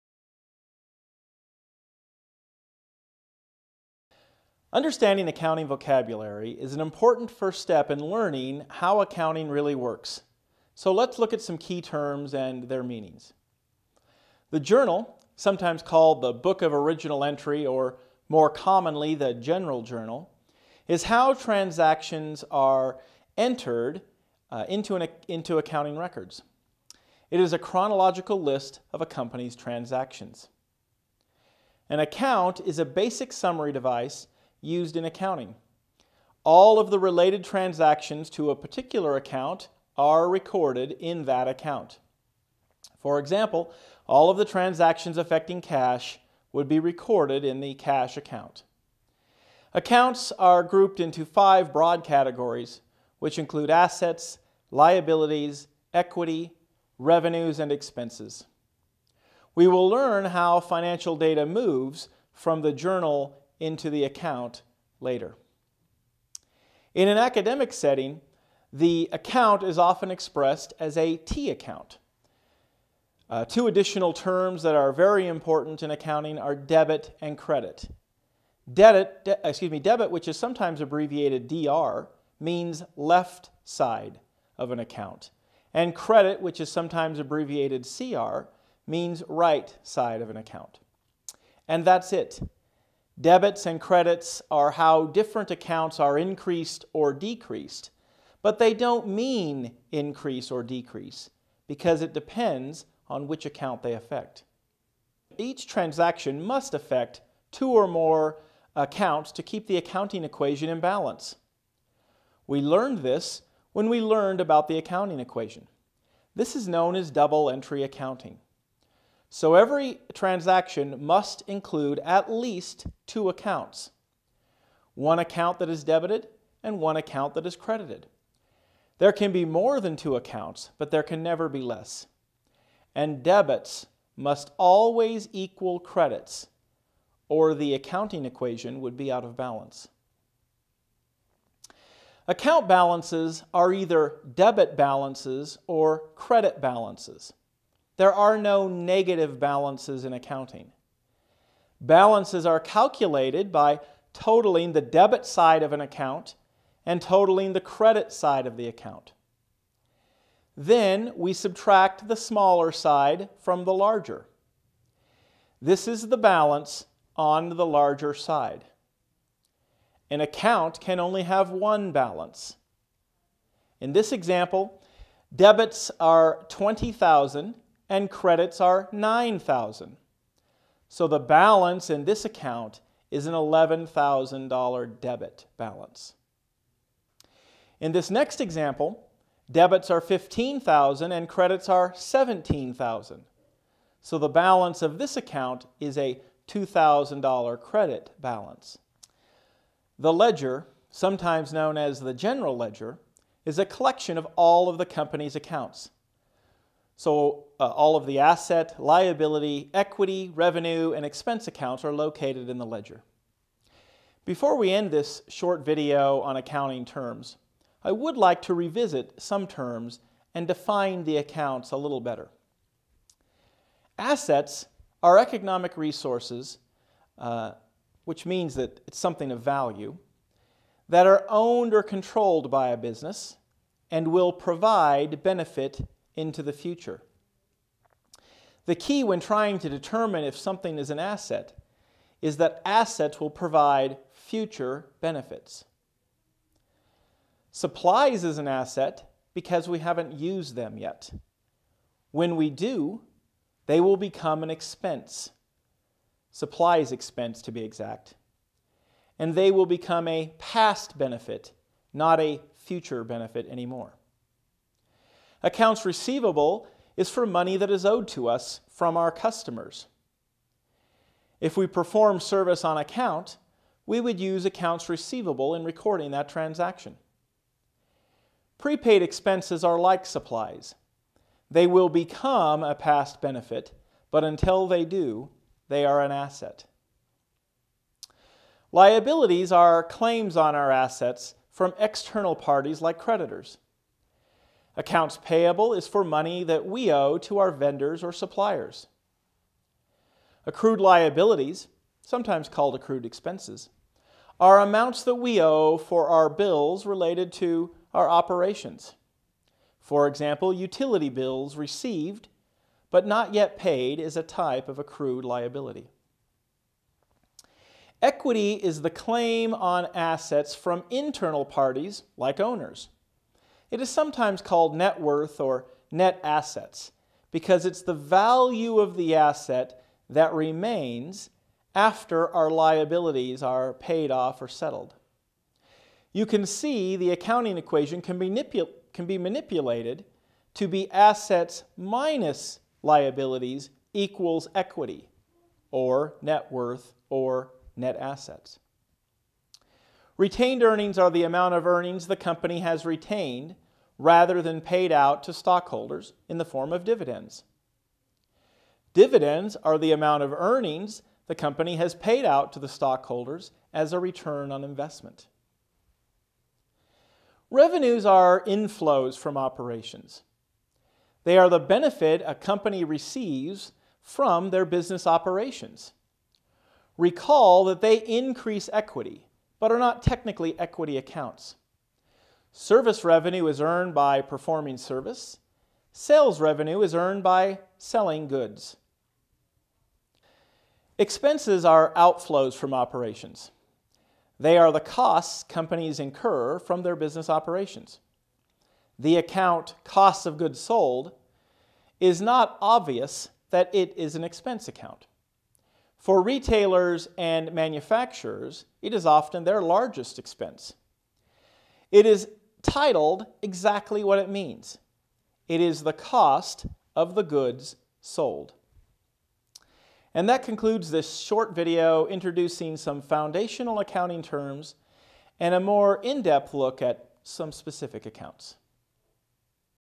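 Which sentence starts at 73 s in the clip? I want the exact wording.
Uh, two additional terms that are very important in accounting are debit and credit.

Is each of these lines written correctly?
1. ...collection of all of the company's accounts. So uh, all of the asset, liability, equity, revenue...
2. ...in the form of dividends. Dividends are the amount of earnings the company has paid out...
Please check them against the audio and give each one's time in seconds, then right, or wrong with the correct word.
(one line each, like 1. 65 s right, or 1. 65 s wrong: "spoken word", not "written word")
1. 203 s right
2. 356 s right.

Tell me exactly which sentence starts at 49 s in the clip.
Accounts are grouped into five broad categories, which include assets, liabilities, equity, revenues, and expenses.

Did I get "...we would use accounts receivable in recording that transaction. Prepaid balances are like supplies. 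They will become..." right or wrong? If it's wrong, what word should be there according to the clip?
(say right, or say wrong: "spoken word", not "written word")
wrong: "expenses", not "balances".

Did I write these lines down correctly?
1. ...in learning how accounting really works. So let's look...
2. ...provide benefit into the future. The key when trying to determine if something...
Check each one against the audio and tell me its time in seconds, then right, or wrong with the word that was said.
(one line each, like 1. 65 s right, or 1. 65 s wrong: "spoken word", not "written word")
1. 7 s right
2. 234 s right.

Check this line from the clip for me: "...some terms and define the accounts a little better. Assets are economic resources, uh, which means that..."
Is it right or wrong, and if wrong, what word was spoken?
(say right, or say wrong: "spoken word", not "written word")
right.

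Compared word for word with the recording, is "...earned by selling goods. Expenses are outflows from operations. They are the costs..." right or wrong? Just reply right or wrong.
right.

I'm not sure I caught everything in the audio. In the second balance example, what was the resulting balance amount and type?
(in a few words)
$2,000 credit balance.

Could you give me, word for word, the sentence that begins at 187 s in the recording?
In this next example, debits are 15,000 and credits are 17,000.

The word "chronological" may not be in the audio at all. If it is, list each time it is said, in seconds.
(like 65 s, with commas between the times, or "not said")
27 s.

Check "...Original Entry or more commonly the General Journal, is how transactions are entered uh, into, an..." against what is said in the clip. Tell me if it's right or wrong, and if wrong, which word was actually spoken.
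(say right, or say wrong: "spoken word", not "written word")
right.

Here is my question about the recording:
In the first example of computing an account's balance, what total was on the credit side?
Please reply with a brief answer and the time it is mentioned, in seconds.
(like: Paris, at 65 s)
9,000, at 178 s.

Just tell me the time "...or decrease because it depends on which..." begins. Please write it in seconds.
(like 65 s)
100 s.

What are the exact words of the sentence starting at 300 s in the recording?
Accrued liabilities, sometimes called accrued expenses, are amounts that we owe for our bills related to our operations.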